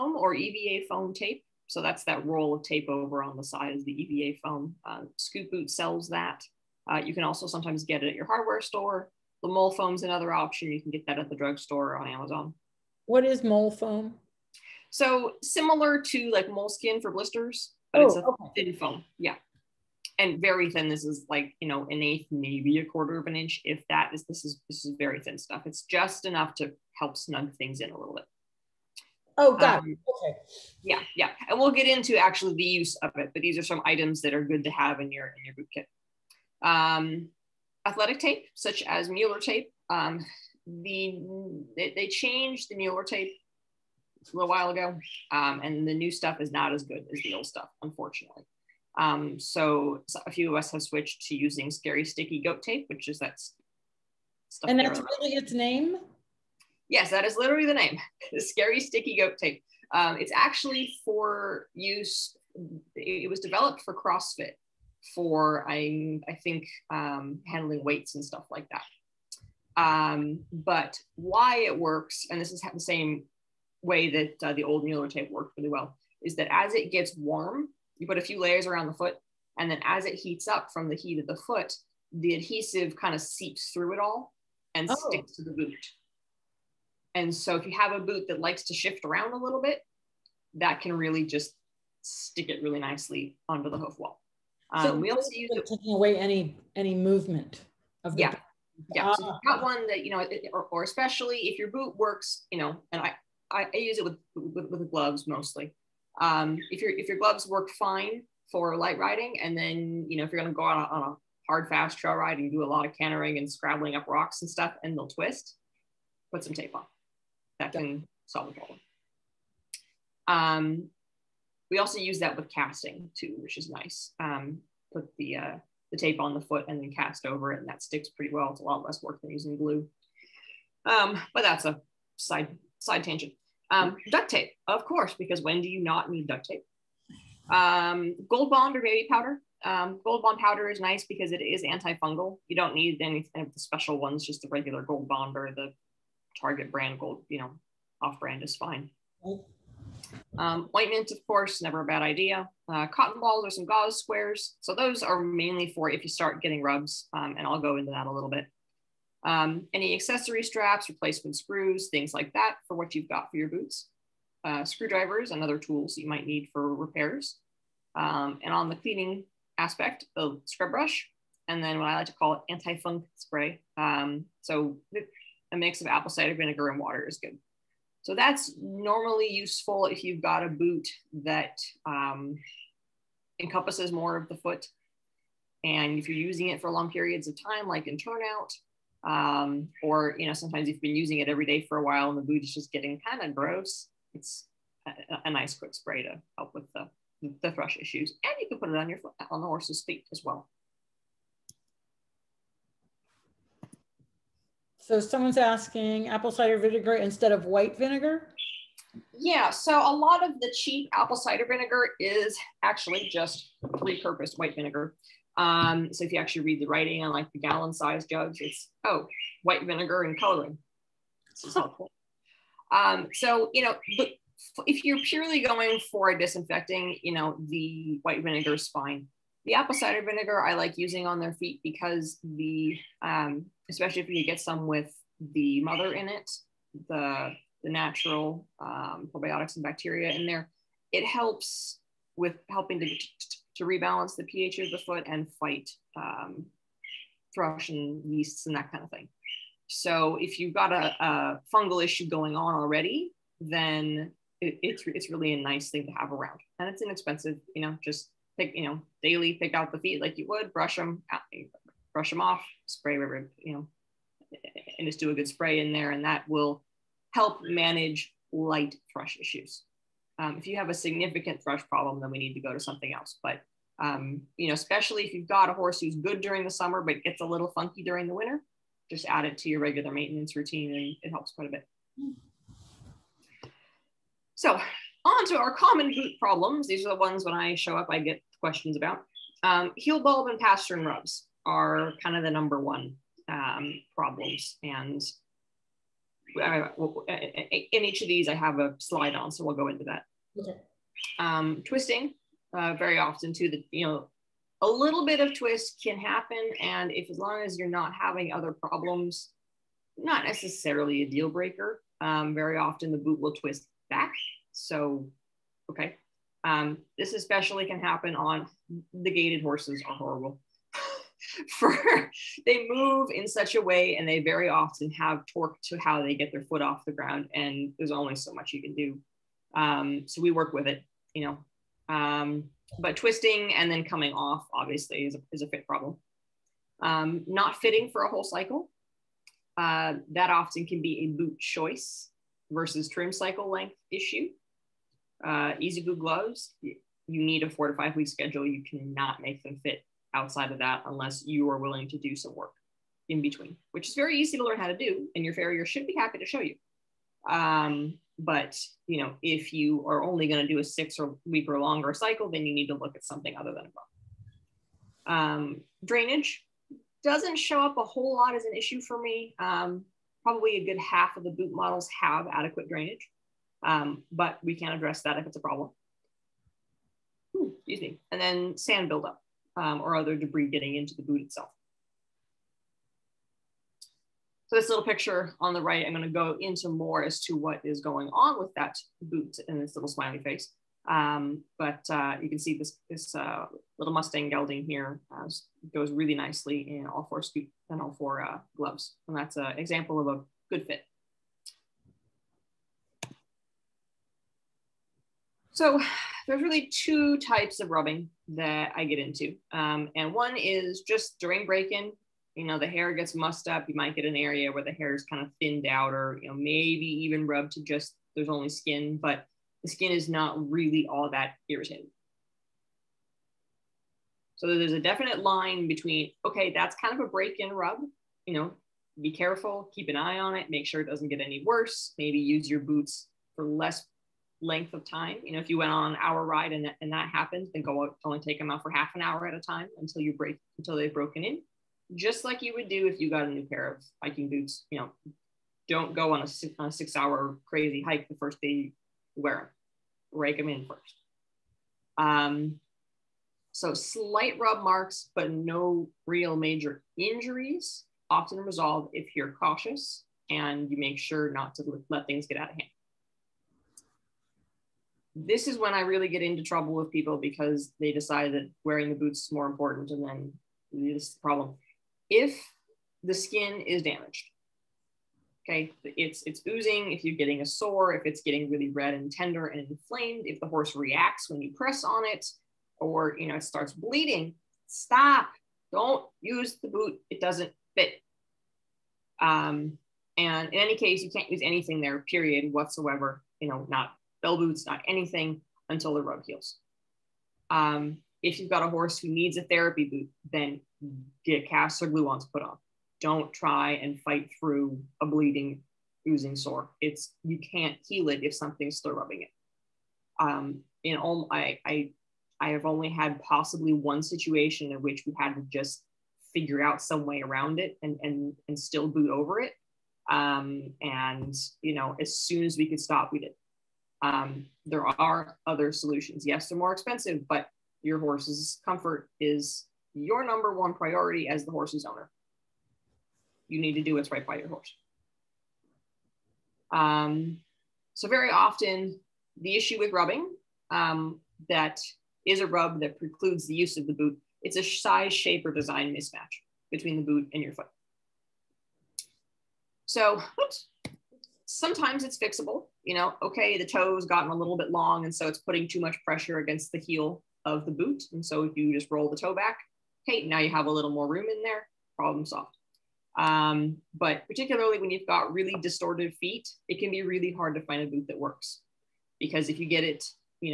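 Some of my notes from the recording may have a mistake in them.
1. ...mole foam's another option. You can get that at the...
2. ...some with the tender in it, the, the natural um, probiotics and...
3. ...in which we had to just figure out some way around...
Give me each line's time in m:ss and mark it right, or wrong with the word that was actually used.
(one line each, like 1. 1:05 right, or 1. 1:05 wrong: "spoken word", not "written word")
1. 0:09 right
2. 3:54 wrong: "mother", not "tender"
3. 8:34 right.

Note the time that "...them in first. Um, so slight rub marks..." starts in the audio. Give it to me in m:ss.
7:30.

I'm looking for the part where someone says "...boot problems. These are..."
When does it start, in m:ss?
4:45.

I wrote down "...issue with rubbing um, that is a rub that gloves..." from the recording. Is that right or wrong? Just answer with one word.
wrong.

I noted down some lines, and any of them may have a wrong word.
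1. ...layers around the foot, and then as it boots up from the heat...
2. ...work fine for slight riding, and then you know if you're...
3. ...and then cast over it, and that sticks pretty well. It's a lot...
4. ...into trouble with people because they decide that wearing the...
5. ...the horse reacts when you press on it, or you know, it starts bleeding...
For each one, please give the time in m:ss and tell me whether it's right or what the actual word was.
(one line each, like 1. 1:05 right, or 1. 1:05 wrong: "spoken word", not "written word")
1. 1:18 wrong: "heats", not "boots"
2. 1:47 wrong: "light", not "slight"
3. 2:06 right
4. 7:46 right
5. 8:00 right.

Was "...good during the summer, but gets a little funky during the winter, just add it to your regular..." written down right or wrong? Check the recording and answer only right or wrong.
right.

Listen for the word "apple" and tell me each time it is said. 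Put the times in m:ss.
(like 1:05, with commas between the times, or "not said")
2:55, 3:26, 3:30, 3:49.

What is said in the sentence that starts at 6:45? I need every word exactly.
So there's really two types of rubbing that I get into.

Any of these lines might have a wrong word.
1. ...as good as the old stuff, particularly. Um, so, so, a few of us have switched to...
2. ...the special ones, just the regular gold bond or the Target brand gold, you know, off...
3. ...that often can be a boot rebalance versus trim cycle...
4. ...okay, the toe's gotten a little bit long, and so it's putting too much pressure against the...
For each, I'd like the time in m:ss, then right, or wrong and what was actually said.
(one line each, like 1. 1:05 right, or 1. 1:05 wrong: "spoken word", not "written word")
1. 0:46 wrong: "unfortunately", not "particularly"
2. 2:23 right
3. 5:40 wrong: "choice", not "rebalance"
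4. 9:13 right.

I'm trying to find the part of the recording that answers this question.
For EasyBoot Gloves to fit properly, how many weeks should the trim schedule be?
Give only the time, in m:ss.
5:47.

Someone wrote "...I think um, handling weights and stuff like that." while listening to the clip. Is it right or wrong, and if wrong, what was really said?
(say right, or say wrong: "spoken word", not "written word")
right.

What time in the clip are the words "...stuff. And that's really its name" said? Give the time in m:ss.
0:54.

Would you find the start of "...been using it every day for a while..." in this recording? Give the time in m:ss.
3:10.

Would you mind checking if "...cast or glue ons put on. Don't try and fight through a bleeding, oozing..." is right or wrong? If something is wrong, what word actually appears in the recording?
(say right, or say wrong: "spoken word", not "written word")
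right.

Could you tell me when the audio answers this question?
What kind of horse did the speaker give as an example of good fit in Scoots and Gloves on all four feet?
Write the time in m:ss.
6:33.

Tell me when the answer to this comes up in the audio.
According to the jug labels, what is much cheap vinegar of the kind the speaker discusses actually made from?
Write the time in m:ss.
3:39.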